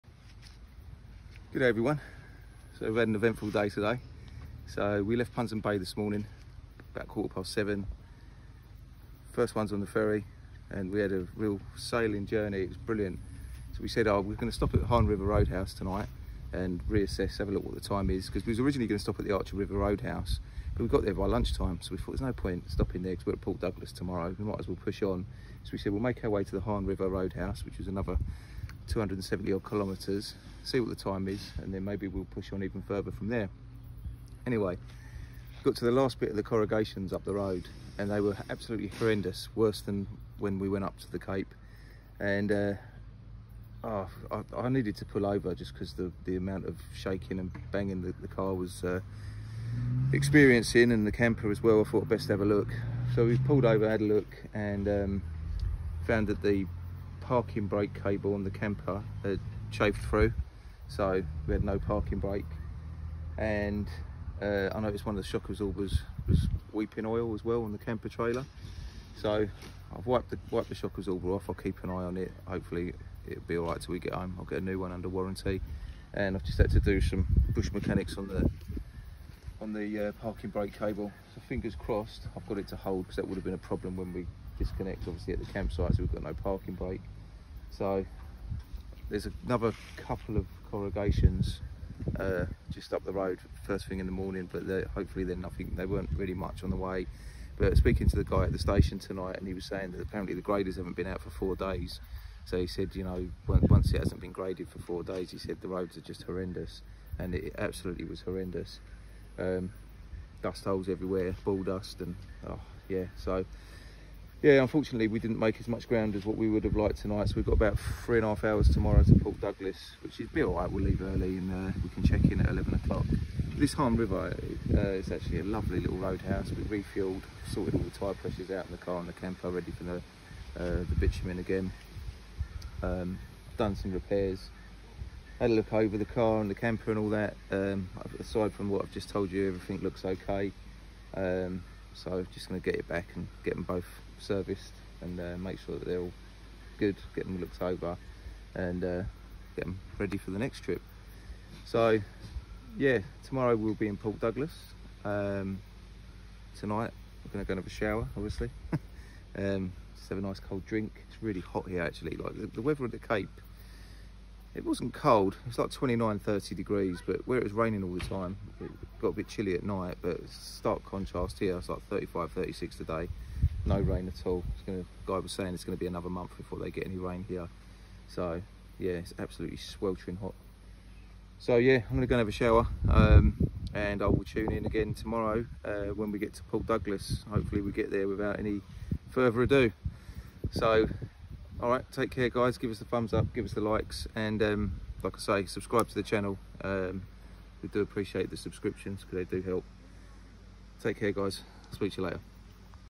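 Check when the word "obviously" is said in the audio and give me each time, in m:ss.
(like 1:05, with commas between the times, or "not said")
1:25, 2:38.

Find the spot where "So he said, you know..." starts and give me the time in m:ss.
1:42.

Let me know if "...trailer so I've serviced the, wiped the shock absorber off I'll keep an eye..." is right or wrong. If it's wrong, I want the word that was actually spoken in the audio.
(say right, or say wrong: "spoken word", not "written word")
wrong: "wiped", not "serviced".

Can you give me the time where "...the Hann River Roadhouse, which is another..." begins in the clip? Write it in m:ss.
0:26.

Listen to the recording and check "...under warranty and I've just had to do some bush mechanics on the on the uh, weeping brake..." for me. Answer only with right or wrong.
wrong.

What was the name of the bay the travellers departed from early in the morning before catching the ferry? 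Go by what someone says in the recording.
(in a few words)
Punsand Bay.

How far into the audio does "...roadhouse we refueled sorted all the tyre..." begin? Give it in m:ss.
2:05.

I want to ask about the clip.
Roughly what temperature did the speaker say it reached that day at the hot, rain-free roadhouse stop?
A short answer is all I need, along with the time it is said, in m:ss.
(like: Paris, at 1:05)
35-36 degrees, at 2:51.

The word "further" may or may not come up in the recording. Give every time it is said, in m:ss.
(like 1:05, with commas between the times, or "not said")
0:32, 3:09.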